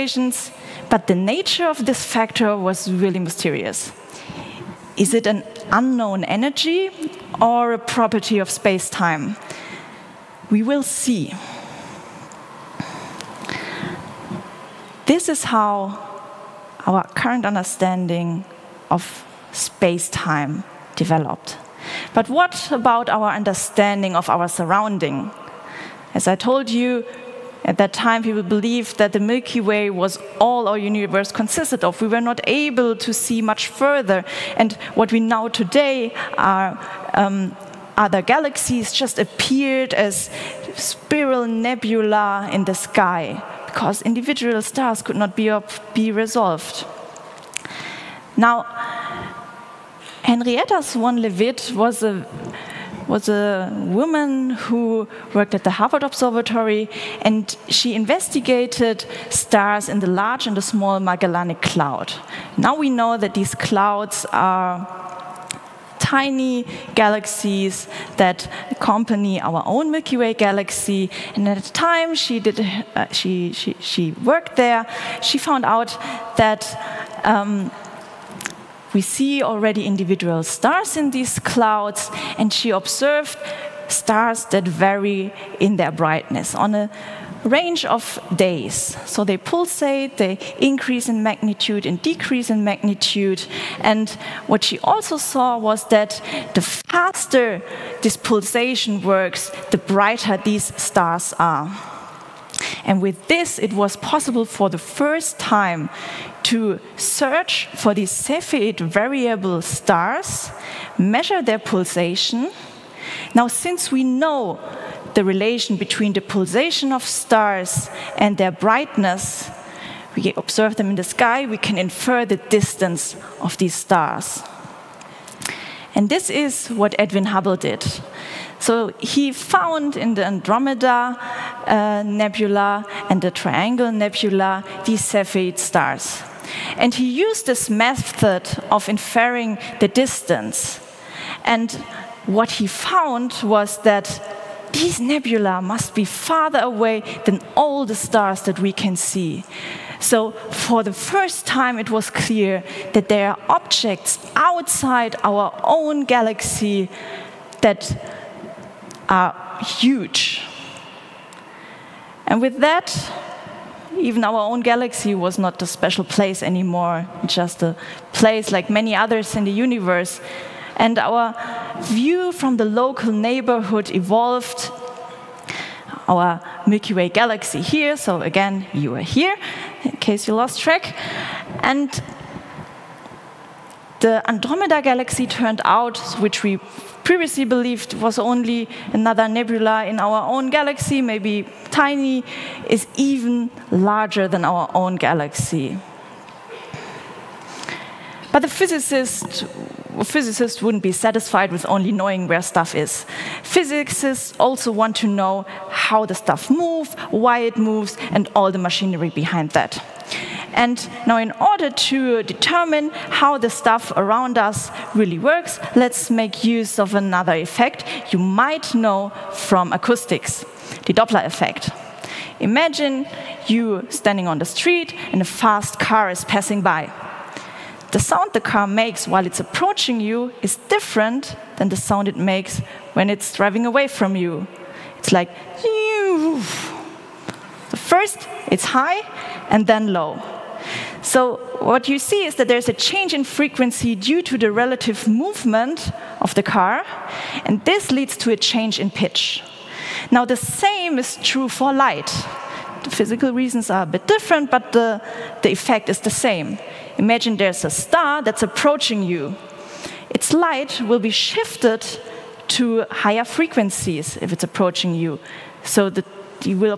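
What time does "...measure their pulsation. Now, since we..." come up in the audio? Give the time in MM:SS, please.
01:50.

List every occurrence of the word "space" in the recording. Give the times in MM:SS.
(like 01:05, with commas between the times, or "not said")
00:08, 00:19.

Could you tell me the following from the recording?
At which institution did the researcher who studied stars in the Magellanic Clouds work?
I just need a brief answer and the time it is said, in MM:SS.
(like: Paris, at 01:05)
Harvard Observatory, at 00:55.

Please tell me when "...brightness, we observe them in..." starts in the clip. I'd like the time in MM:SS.
01:58.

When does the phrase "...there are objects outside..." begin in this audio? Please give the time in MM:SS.
02:33.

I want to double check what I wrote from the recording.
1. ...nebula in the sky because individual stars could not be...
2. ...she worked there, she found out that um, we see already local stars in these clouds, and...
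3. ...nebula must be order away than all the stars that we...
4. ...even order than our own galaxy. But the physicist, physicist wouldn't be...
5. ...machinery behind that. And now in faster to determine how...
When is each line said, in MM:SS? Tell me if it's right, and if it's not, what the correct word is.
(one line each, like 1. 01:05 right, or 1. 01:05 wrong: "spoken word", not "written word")
1. 00:41 right
2. 01:13 wrong: "individual", not "local"
3. 02:24 wrong: "farther", not "order"
4. 03:12 wrong: "larger", not "order"
5. 03:28 wrong: "order", not "faster".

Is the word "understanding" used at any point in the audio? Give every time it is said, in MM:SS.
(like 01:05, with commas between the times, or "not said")
00:17, 00:23.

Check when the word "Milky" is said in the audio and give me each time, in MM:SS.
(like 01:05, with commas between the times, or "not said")
00:29, 01:09, 02:56.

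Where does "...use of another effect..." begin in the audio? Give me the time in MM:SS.
03:36.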